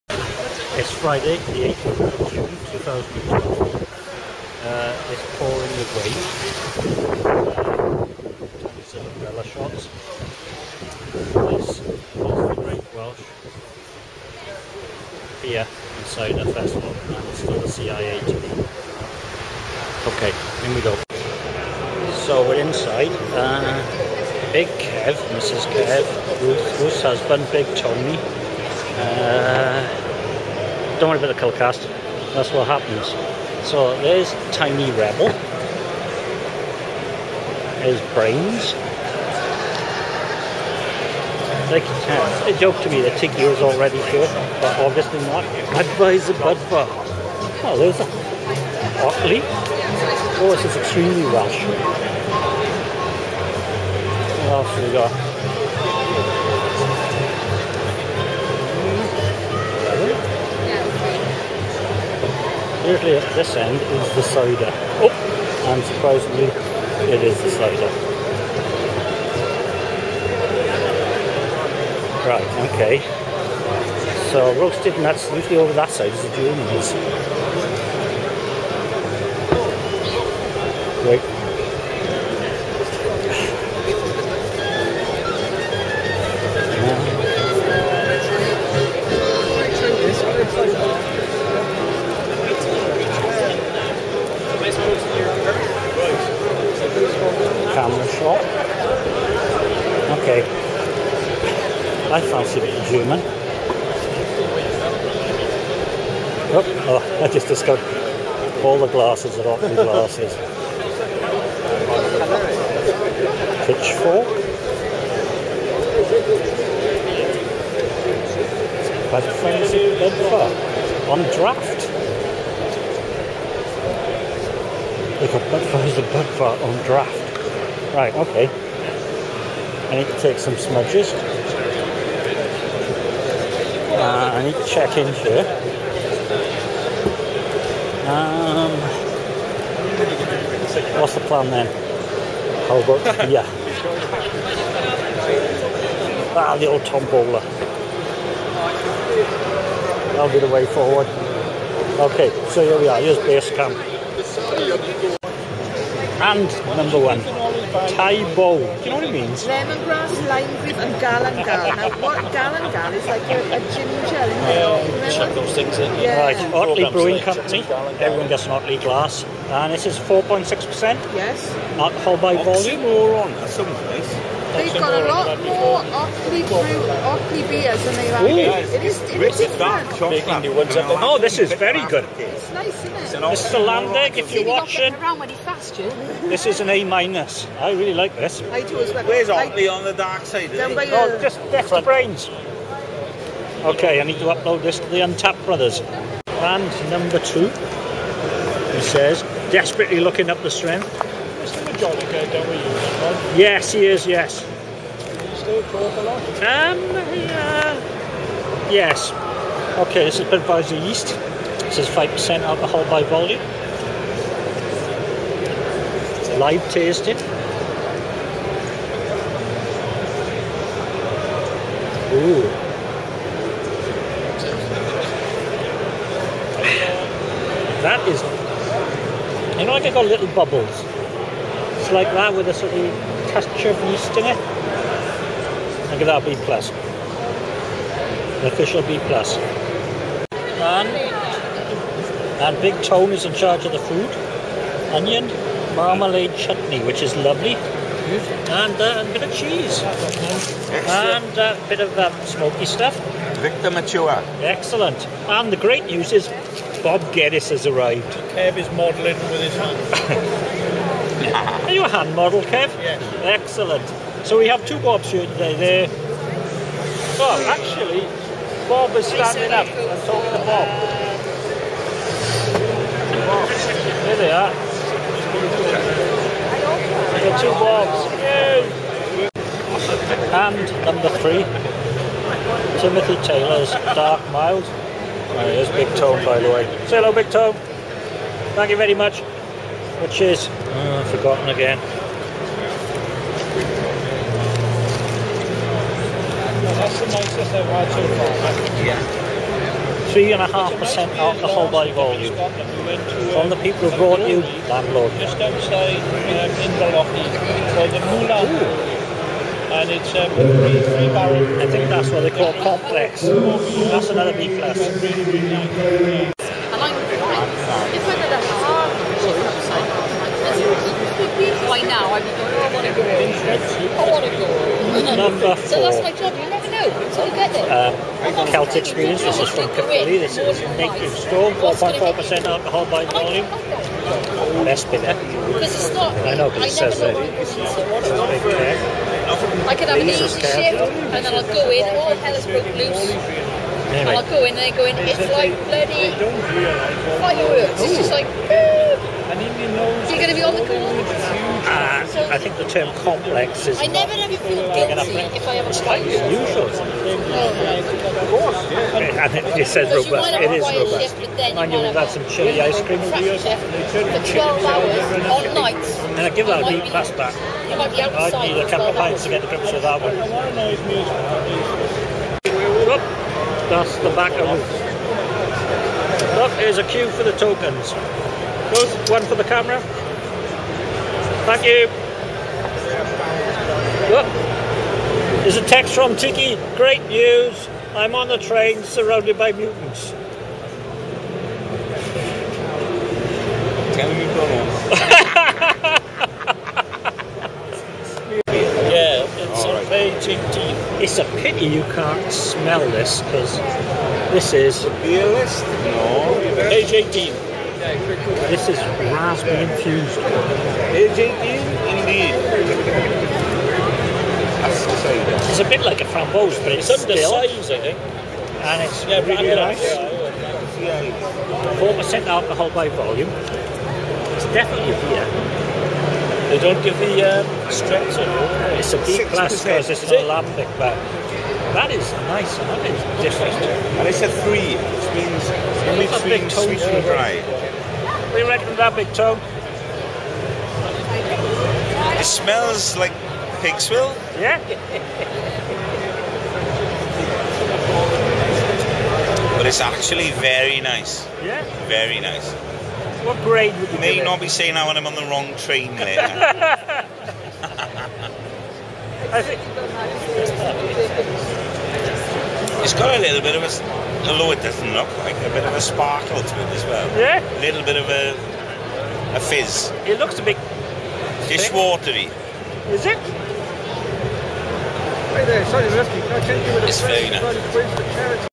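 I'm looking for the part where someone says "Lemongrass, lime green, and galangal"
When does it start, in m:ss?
2:39.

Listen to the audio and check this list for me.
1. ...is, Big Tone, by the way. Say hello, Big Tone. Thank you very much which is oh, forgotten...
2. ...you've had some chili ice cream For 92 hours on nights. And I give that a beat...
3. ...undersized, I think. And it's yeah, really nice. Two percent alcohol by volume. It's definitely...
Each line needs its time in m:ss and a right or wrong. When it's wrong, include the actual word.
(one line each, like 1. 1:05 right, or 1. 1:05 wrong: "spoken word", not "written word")
1. 4:45 right
2. 6:01 wrong: "12", not "92"
3. 6:56 wrong: "Four", not "Two".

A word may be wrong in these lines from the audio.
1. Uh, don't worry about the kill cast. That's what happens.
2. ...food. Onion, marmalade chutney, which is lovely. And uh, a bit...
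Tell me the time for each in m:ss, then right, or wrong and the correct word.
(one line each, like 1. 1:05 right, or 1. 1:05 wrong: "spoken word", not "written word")
1. 0:28 right
2. 4:03 right.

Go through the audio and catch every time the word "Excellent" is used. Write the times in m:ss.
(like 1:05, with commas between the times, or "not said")
4:14, 4:23.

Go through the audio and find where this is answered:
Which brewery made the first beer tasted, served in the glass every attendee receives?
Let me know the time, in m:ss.
2:46.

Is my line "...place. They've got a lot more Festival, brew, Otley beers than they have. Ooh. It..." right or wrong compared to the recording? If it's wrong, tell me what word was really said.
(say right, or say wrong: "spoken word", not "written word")
wrong: "Otley", not "Festival".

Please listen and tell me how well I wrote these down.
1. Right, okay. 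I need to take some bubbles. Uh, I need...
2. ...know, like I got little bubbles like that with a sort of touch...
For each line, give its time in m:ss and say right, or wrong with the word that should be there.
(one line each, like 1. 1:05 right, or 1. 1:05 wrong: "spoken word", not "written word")
1. 2:07 wrong: "smudges", not "bubbles"
2. 3:49 right.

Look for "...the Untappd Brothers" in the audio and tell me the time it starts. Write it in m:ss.
3:14.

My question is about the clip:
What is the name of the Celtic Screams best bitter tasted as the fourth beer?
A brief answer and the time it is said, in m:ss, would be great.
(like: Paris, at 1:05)
Native Storm, at 5:30.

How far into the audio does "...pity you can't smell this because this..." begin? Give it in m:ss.
6:41.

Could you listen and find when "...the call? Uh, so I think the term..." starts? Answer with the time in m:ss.
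5:50.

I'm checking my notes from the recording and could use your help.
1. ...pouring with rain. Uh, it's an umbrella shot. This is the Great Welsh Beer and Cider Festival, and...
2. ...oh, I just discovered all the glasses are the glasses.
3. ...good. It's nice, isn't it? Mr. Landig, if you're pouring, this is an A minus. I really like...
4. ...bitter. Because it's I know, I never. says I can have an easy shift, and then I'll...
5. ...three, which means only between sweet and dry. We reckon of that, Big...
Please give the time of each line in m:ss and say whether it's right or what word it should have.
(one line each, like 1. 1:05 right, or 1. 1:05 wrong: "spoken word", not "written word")
1. 0:05 right
2. 1:46 right
3. 3:01 wrong: "watching", not "pouring"
4. 5:34 right
5. 7:14 right.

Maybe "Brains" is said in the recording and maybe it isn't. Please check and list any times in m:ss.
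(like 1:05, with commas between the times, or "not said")
0:38, 3:11.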